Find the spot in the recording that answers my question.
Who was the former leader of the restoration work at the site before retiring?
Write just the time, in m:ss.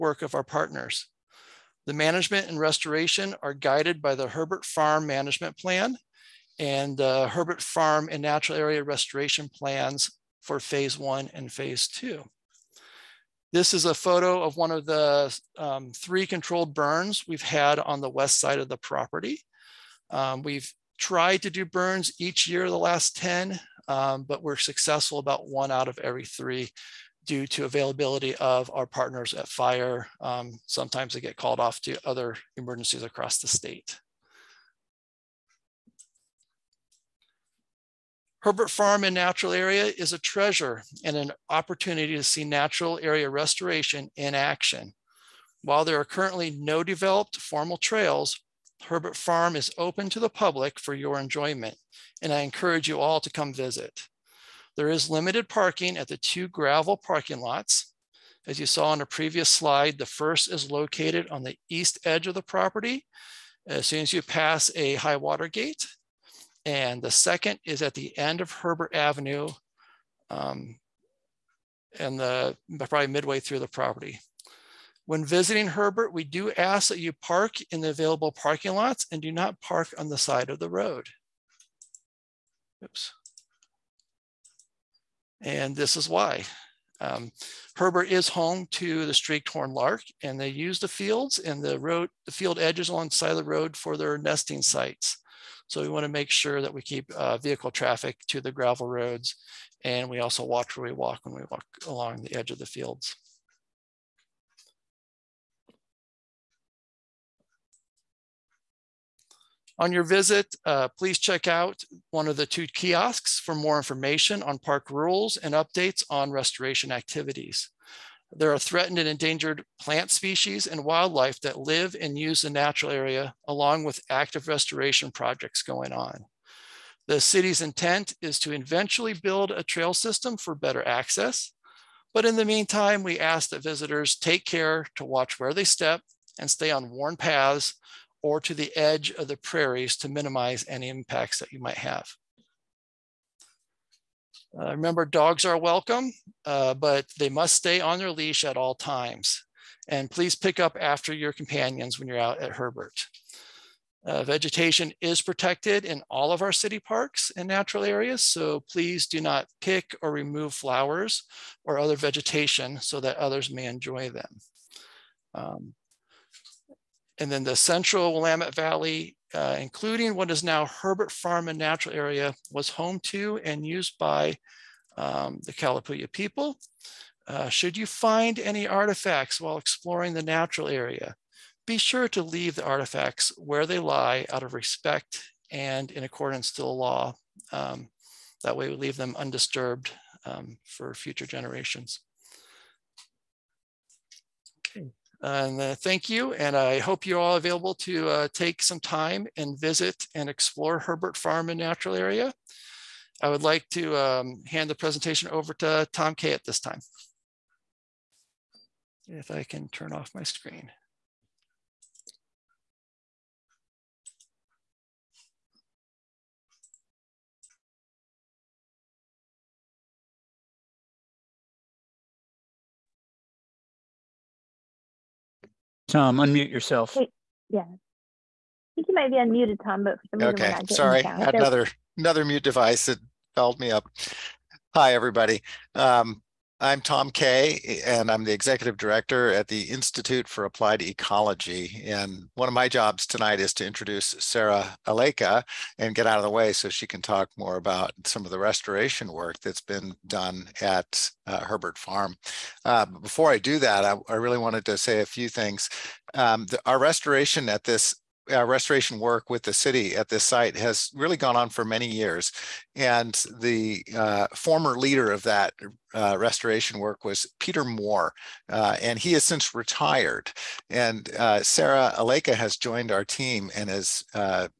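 4:27.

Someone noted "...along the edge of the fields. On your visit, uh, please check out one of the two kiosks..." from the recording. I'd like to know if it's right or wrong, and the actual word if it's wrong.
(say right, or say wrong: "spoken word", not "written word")
right.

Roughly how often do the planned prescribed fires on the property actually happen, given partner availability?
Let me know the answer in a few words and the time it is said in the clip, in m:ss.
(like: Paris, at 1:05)
1 out of every 3, at 0:25.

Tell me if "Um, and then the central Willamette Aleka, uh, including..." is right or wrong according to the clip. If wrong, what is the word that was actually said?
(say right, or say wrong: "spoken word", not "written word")
wrong: "Valley", not "Aleka".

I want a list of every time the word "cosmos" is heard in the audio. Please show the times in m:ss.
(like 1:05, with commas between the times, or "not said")
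not said.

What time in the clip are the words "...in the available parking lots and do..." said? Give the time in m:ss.
1:17.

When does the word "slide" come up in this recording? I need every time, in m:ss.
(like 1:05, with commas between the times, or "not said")
0:59.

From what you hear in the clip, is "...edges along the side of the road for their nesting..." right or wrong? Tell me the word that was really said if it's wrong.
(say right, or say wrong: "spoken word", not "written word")
right.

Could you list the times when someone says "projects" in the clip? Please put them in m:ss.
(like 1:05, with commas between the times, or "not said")
2:05.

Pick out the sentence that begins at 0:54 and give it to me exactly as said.
There is limited parking at the two gravel parking lots.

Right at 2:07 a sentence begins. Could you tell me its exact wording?
The city's intent is to eventually build a trail system for better access.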